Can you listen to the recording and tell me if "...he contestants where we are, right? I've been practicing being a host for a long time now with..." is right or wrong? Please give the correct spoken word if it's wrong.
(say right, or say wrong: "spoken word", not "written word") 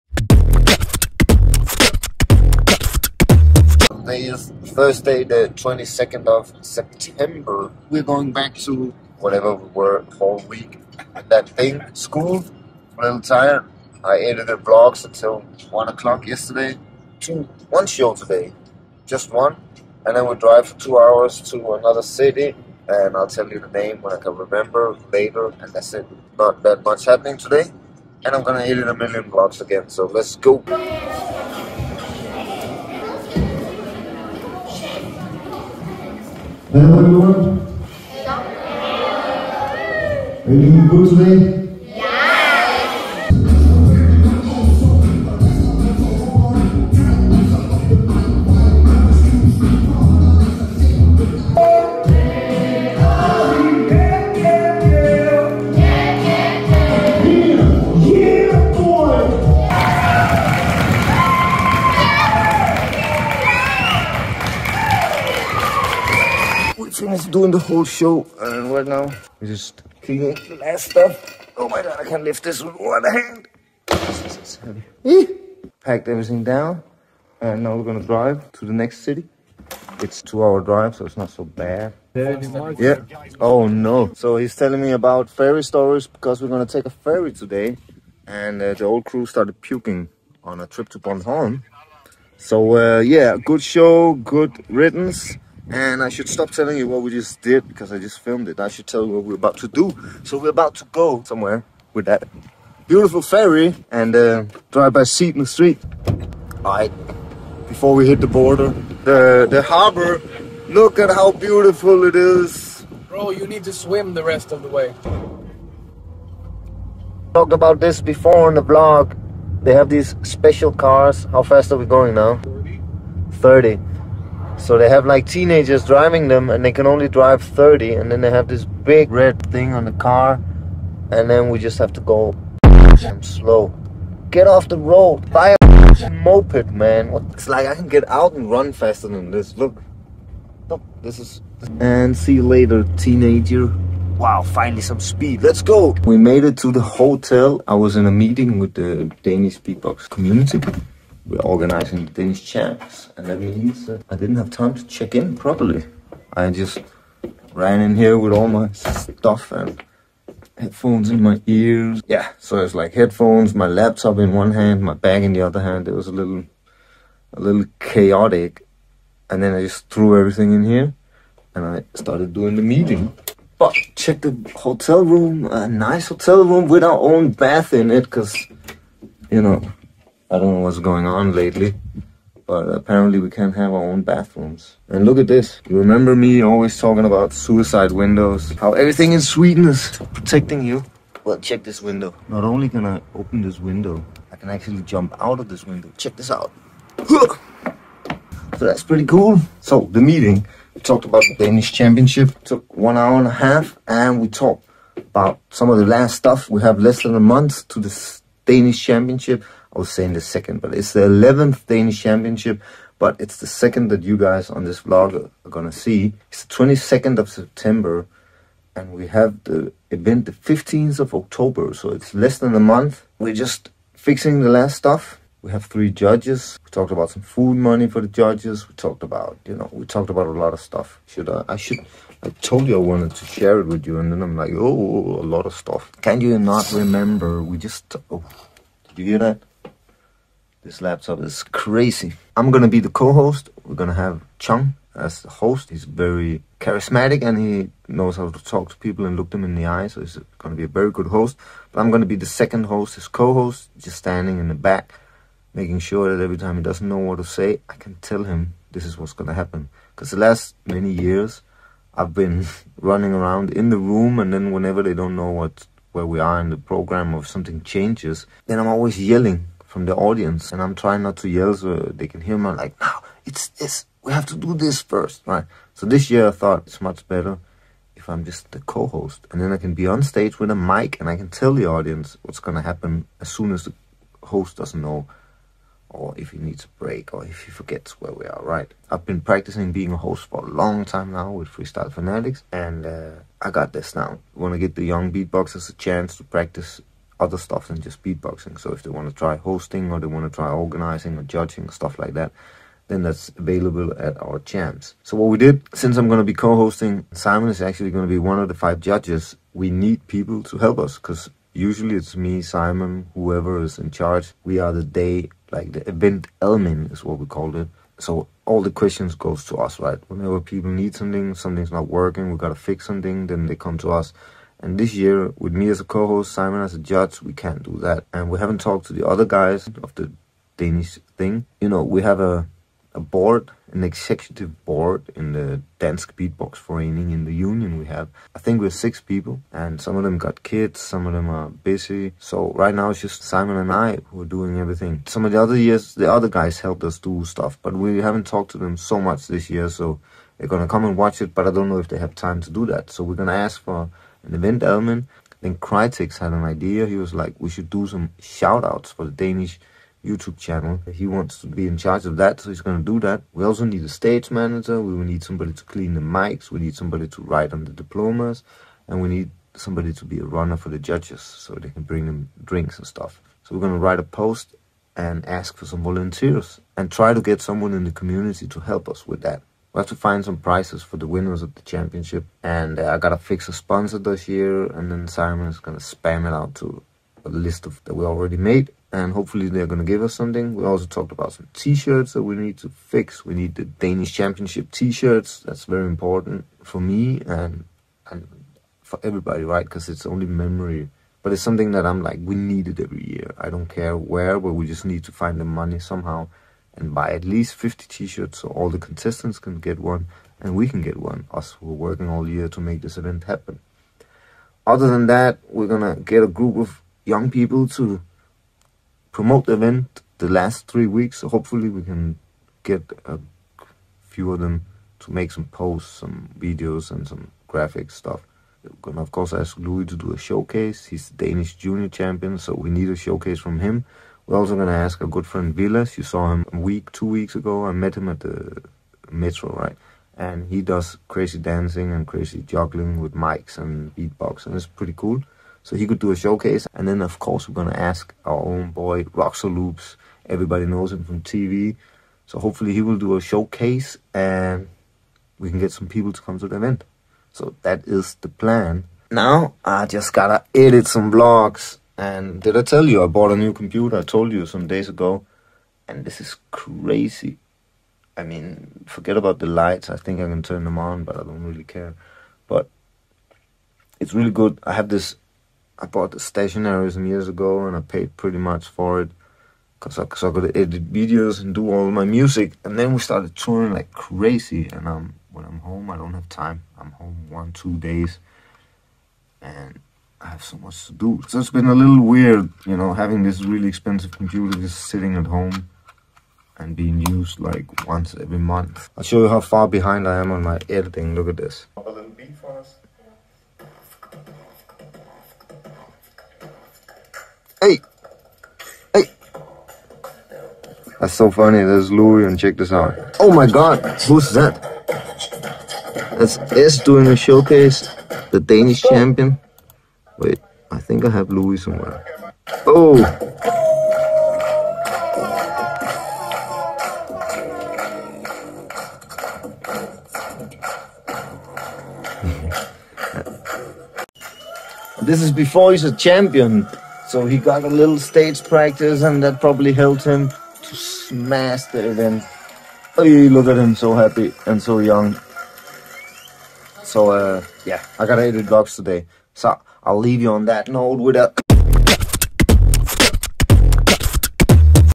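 wrong: "forgets", not "contestants".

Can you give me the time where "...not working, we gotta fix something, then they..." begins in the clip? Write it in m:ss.
5:21.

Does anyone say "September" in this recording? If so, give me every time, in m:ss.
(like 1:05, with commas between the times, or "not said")
0:06, 3:37.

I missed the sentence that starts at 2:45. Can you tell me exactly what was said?
It was a little, a little chaotic.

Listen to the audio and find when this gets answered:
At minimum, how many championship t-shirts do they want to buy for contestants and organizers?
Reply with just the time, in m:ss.
6:47.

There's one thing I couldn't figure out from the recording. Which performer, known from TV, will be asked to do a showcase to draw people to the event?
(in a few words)
Roxo Loops.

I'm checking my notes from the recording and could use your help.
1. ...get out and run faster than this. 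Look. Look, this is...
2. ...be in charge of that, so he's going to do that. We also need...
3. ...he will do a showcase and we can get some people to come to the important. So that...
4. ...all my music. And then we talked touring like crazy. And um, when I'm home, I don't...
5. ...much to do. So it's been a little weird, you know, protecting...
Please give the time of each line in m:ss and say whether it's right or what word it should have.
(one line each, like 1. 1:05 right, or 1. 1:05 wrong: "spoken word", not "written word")
1. 2:17 right
2. 6:01 right
3. 7:32 wrong: "event", not "important"
4. 8:01 wrong: "started", not "talked"
5. 8:10 wrong: "having", not "protecting".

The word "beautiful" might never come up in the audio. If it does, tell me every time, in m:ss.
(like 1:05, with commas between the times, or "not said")
1:42, 1:51.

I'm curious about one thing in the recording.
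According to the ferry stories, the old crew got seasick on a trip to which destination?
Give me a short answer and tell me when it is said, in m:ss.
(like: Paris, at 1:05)
Bornholm, at 1:30.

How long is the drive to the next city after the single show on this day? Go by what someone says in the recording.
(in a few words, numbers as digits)
2 hours.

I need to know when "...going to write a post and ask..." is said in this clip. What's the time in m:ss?
6:13.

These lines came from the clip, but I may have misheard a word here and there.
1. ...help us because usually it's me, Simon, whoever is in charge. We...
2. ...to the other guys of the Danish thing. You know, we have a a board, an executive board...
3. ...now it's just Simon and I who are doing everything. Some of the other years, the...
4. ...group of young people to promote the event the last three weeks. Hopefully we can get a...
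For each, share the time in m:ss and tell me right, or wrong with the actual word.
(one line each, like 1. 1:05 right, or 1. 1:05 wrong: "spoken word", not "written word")
1. 5:10 right
2. 5:28 right
3. 5:42 right
4. 6:56 right.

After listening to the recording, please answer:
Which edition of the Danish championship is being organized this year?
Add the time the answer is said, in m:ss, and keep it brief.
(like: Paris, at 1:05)
11th, at 3:31.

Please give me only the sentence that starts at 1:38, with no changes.
I should tell you what we're about to do.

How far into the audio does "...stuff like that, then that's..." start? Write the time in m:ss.
5:01.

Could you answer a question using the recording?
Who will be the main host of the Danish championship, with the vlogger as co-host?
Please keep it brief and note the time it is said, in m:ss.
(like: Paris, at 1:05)
Chung, at 4:04.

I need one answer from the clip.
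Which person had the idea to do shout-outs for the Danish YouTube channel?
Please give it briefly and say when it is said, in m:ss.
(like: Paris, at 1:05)
Crytex, at 5:55.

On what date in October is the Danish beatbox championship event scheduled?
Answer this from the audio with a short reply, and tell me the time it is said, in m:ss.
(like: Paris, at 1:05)
15th of October, at 3:40.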